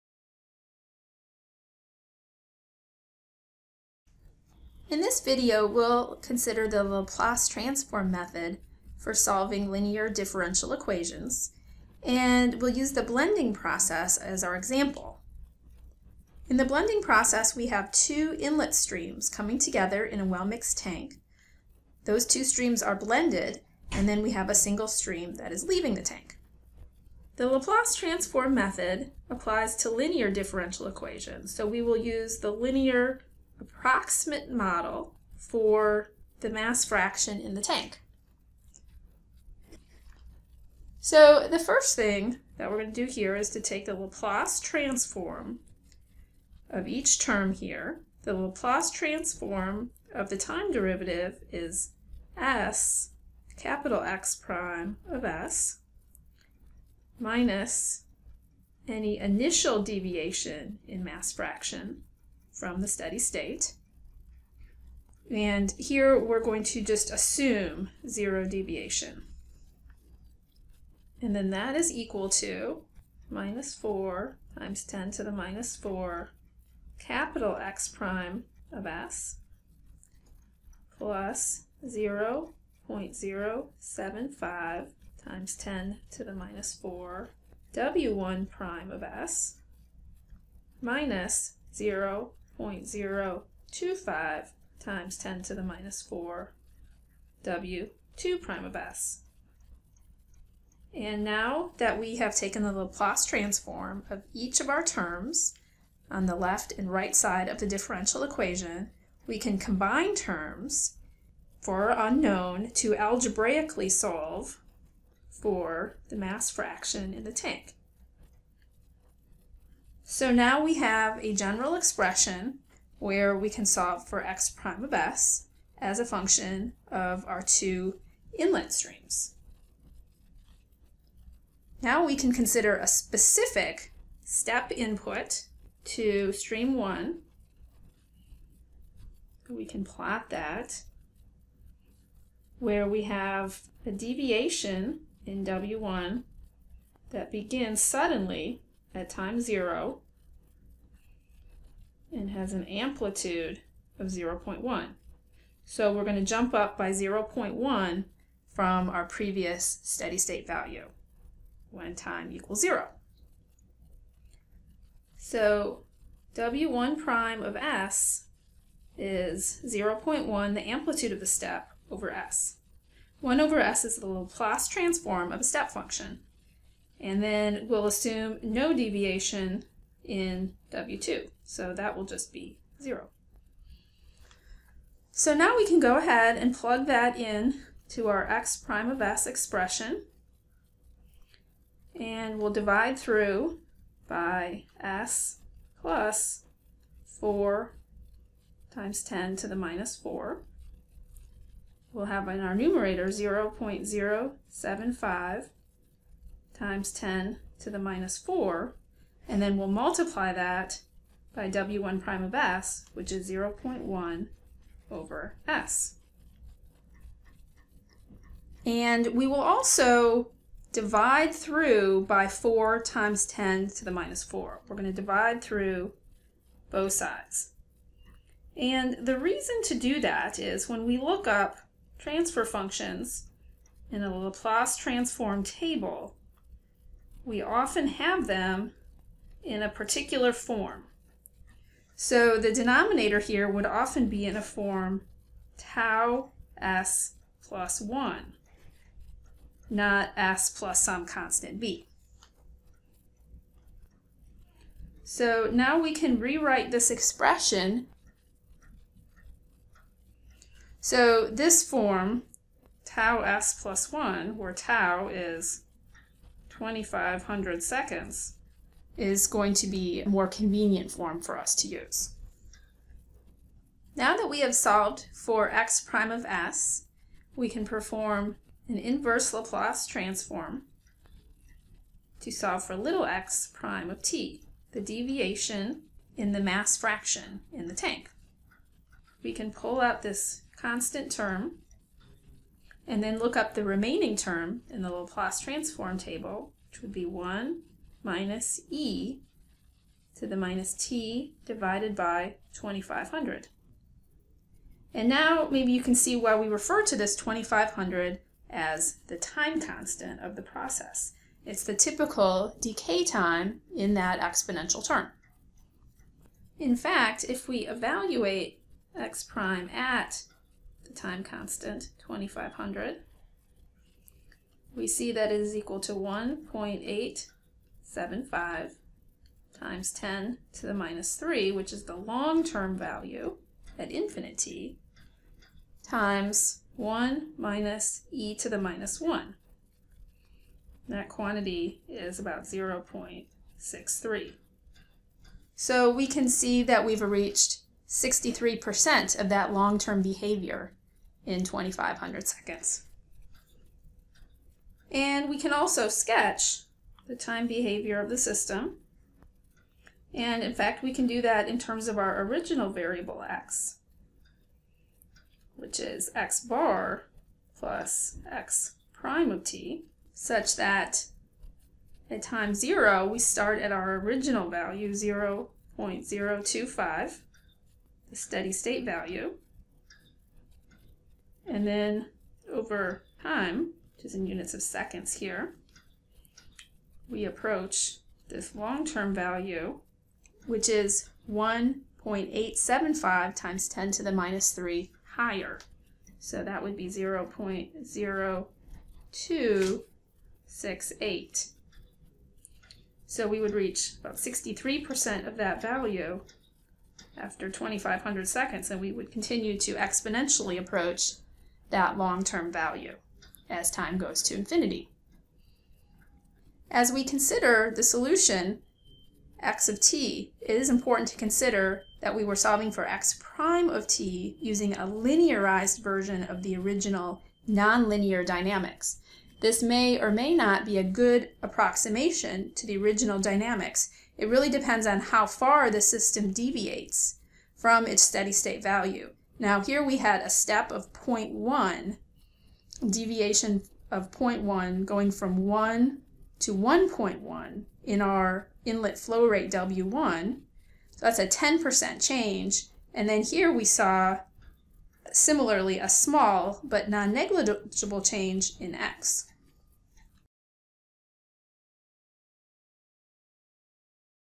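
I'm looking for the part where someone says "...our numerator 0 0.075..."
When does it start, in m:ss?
3:22.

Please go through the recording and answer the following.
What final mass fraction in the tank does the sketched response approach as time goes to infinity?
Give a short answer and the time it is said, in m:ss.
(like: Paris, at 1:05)
0.0268, at 6:36.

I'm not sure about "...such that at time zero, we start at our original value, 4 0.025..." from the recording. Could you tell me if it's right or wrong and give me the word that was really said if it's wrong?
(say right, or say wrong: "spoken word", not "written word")
wrong: "0", not "4".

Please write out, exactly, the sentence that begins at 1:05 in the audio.
And here we're going to just assume zero deviation.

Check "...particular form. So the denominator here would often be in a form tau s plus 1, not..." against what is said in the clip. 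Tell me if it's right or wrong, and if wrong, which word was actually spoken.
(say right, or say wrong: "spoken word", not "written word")
right.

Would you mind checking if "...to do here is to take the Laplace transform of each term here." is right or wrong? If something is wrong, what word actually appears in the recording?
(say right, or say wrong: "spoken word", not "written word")
right.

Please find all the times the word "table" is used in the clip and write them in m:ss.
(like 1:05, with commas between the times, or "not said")
3:55, 4:55.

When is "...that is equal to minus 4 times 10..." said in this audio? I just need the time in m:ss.
1:11.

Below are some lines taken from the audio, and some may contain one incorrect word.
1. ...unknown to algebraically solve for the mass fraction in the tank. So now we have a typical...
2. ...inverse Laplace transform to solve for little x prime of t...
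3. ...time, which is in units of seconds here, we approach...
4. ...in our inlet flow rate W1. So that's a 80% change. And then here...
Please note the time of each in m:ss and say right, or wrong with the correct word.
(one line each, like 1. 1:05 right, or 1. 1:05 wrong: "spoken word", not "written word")
1. 1:52 wrong: "general", not "typical"
2. 4:38 right
3. 6:23 right
4. 7:27 wrong: "10", not "80".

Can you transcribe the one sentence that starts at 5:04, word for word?
And now maybe you can see why we refer to this 2500 as the time constant of the process.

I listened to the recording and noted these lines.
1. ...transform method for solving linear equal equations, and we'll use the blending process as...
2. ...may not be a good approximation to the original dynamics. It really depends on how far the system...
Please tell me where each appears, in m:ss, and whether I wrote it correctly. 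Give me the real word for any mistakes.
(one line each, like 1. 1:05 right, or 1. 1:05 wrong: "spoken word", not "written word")
1. 0:07 wrong: "differential", not "equal"
2. 7:10 right.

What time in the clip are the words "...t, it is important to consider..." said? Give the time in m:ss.
6:59.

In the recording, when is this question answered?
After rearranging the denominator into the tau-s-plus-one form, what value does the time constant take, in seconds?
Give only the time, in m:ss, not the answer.
4:24.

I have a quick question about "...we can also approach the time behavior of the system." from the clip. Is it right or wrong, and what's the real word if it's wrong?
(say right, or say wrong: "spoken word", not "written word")
wrong: "sketch", not "approach".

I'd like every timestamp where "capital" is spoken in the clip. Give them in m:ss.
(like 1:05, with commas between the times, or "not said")
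0:53, 1:16.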